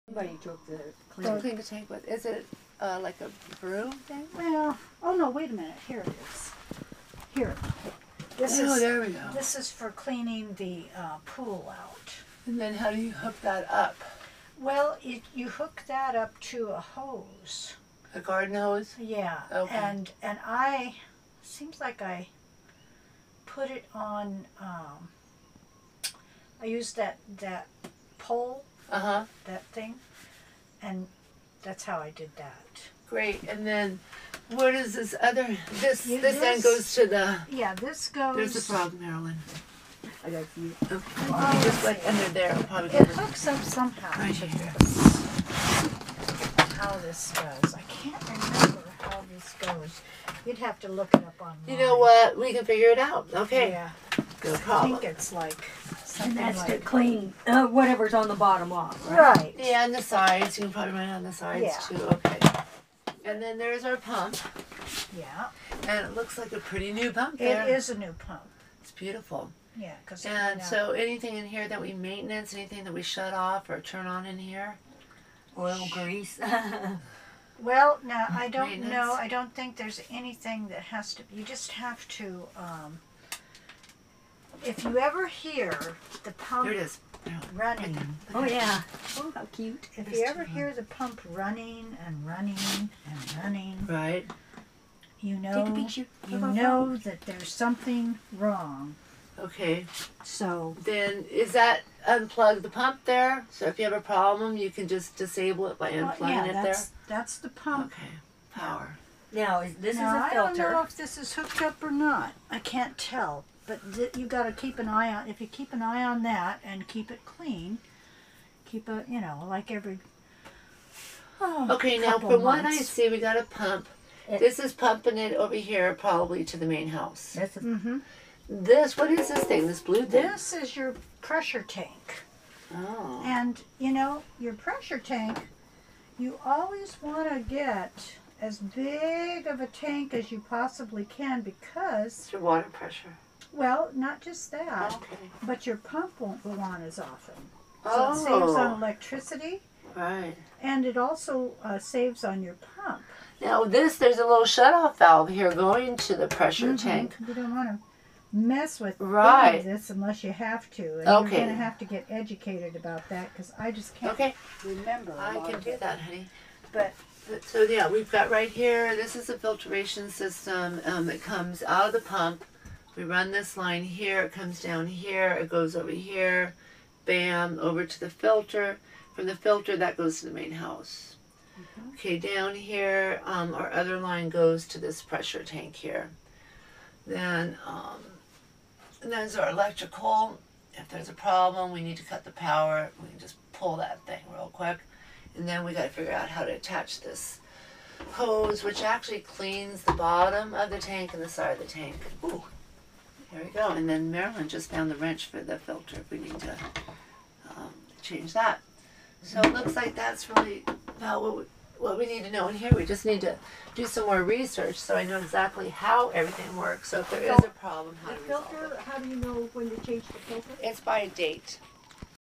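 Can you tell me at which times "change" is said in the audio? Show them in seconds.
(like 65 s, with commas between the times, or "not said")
208 s, 219 s.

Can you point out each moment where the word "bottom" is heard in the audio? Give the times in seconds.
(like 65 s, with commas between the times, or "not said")
58 s, 199 s.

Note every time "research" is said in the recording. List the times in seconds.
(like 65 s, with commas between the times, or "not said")
214 s.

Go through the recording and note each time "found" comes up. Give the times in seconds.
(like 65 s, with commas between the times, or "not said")
204 s.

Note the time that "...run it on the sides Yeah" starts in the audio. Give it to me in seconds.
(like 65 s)
60 s.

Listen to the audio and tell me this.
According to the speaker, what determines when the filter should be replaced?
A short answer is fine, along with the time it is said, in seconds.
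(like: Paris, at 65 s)
A date, at 220 s.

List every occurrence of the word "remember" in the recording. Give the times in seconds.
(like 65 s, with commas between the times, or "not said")
48 s, 164 s.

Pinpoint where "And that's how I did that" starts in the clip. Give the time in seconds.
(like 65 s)
30 s.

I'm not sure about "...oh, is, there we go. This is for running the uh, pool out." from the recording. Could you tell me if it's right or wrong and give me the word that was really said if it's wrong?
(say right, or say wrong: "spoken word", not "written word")
wrong: "cleaning", not "running".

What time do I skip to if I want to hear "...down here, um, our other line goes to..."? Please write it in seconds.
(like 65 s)
182 s.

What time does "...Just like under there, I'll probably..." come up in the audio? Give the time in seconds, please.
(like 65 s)
41 s.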